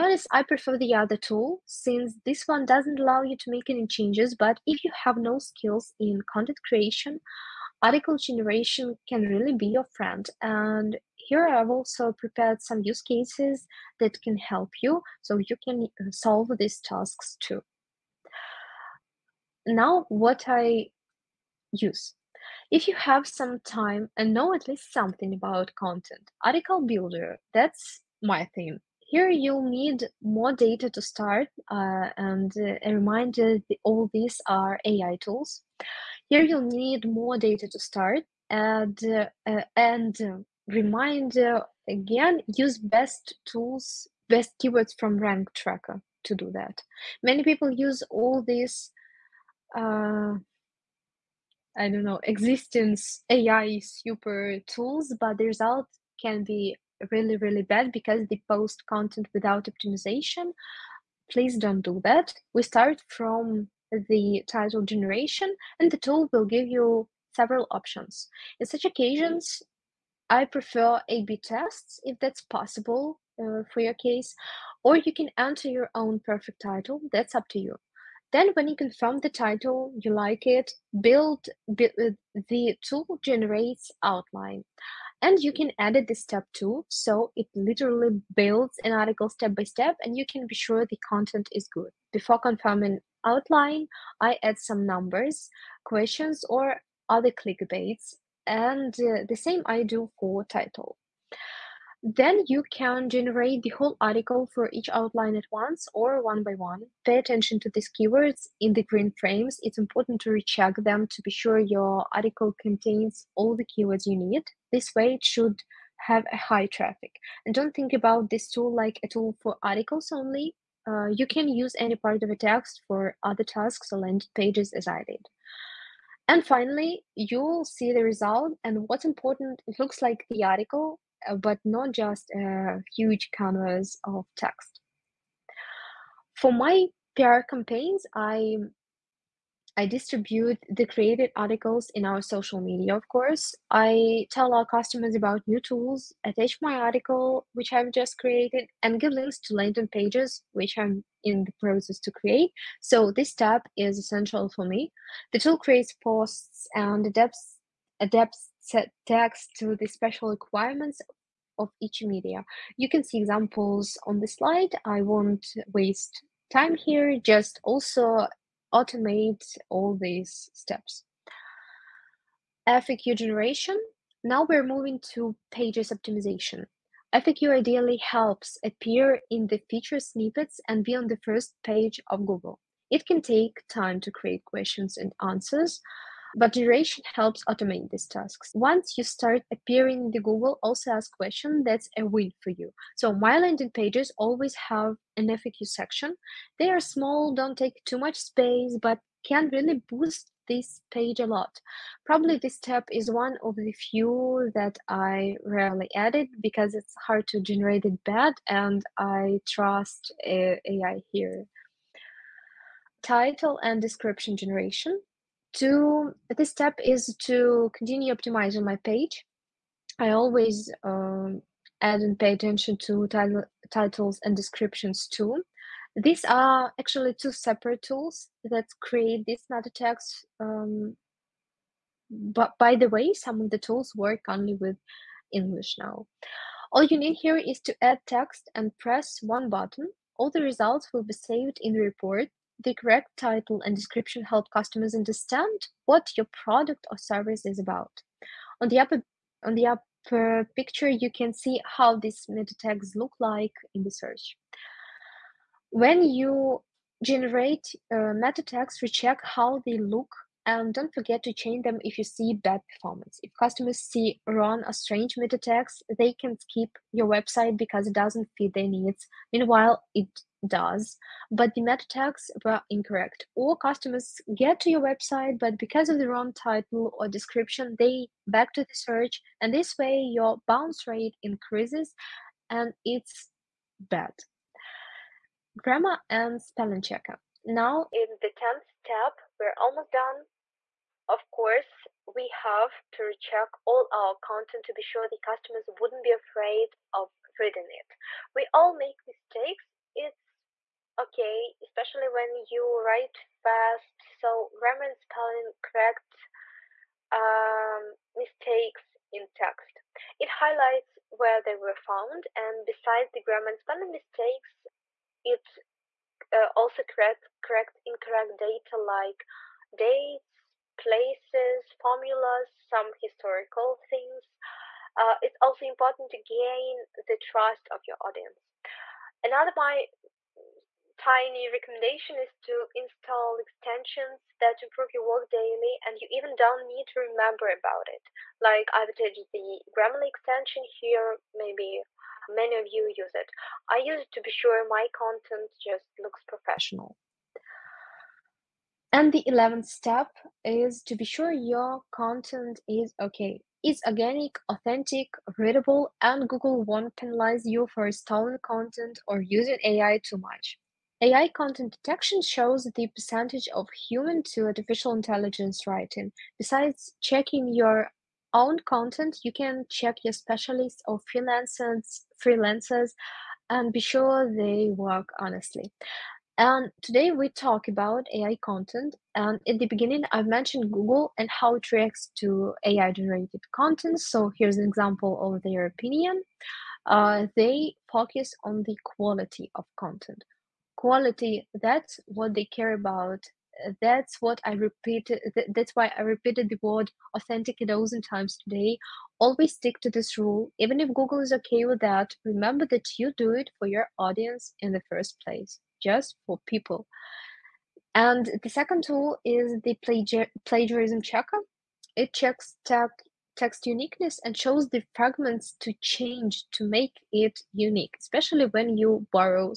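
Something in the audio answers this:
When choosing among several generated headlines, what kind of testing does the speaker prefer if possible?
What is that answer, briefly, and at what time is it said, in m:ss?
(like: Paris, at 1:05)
A-B tests, at 1:11.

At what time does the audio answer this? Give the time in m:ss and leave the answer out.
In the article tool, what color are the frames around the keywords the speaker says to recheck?
1:48.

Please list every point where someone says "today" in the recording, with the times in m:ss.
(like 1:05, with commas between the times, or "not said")
6:16, 6:38.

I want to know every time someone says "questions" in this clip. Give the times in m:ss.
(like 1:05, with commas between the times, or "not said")
1:35, 3:04, 3:11.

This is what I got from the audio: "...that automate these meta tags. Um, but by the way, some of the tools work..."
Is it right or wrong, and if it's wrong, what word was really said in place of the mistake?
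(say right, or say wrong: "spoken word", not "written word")
wrong: "create", not "automate".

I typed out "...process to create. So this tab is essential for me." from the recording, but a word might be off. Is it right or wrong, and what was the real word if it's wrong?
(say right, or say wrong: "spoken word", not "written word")
right.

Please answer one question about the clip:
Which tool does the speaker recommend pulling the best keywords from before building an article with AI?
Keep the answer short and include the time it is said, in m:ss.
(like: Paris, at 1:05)
Rank Tracker, at 0:45.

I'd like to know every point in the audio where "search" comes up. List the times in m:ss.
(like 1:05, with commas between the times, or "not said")
4:13, 4:38.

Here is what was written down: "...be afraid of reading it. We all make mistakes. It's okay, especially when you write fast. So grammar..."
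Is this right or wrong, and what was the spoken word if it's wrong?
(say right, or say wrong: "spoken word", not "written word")
right.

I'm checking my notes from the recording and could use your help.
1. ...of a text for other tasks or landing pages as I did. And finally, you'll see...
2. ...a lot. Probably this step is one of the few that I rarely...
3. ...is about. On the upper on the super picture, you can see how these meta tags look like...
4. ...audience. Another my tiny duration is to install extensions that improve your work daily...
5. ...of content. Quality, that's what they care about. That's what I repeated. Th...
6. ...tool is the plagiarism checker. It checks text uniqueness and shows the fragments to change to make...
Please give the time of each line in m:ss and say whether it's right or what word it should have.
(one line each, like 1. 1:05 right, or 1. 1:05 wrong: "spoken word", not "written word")
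1. 2:02 right
2. 3:21 right
3. 4:07 wrong: "upper", not "super"
4. 5:28 wrong: "recommendation", not "duration"
5. 6:29 right
6. 6:48 right.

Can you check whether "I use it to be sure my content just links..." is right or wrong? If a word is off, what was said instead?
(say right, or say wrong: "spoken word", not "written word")
wrong: "looks", not "links".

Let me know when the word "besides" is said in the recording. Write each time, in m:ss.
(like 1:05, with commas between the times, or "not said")
5:12, 6:06.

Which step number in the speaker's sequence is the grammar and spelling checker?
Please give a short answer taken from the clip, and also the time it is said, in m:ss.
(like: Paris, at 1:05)
10th, at 4:48.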